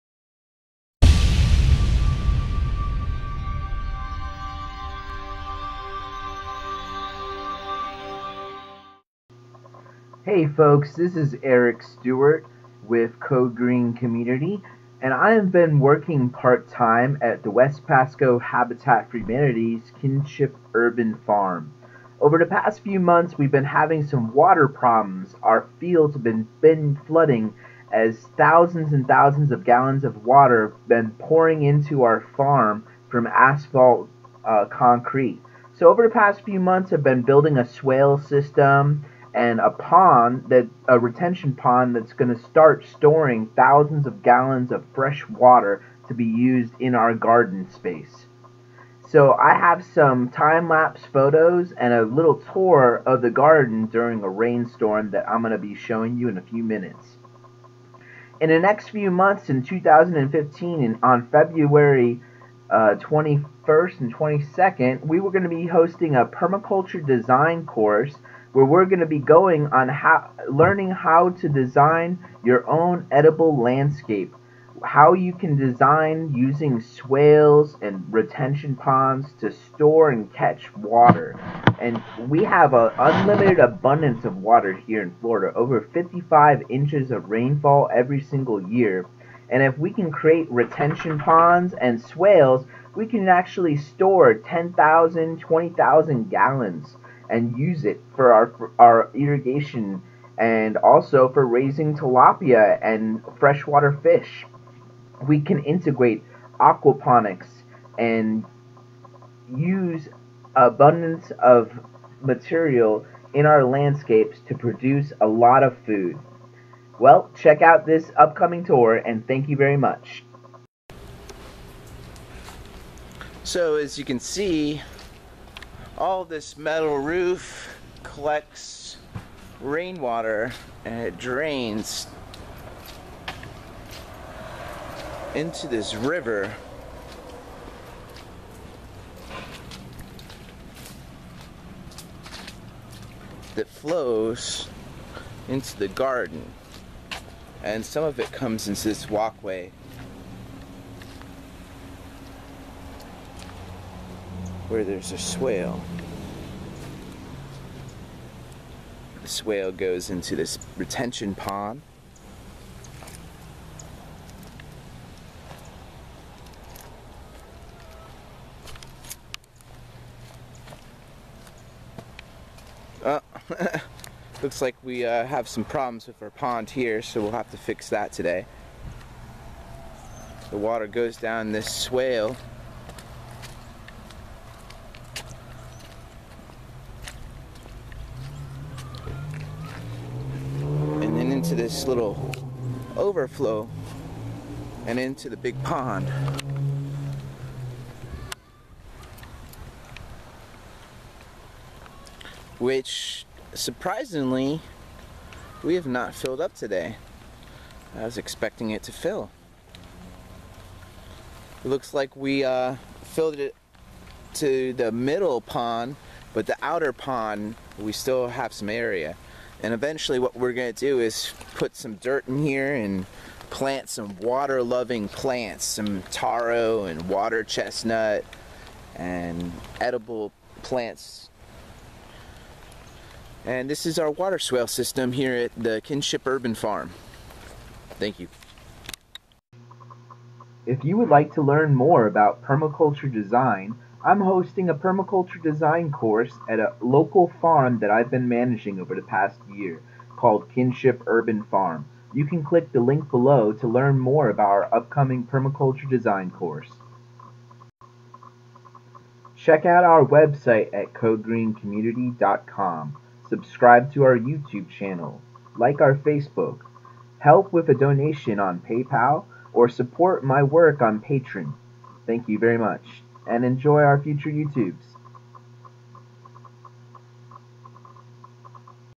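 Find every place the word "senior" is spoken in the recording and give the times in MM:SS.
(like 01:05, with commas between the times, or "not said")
not said.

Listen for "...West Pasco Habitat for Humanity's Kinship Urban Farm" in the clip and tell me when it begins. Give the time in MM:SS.
00:17.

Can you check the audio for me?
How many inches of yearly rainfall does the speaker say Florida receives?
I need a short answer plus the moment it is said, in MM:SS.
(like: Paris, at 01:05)
Over 55 inches, at 01:25.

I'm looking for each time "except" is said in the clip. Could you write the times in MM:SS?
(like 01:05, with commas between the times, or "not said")
not said.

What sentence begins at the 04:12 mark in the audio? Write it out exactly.
You can click the link below to learn more about our upcoming permaculture design course.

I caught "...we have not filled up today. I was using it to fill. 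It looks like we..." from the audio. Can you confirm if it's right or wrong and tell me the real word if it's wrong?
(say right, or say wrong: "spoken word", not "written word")
wrong: "expecting", not "using".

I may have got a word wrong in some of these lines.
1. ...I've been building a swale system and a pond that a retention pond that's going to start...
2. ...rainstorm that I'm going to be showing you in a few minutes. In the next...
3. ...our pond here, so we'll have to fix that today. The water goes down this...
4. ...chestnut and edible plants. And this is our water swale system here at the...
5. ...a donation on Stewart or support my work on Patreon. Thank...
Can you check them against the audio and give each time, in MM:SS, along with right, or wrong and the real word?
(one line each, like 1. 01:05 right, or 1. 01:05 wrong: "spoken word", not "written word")
1. 00:36 right
2. 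00:54 right
3. 02:56 right
4. 03:47 right
5. 04:27 wrong: "PayPal", not "Stewart".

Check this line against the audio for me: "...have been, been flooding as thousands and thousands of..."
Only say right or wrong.
right.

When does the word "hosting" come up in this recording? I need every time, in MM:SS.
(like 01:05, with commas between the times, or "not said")
01:05, 04:04.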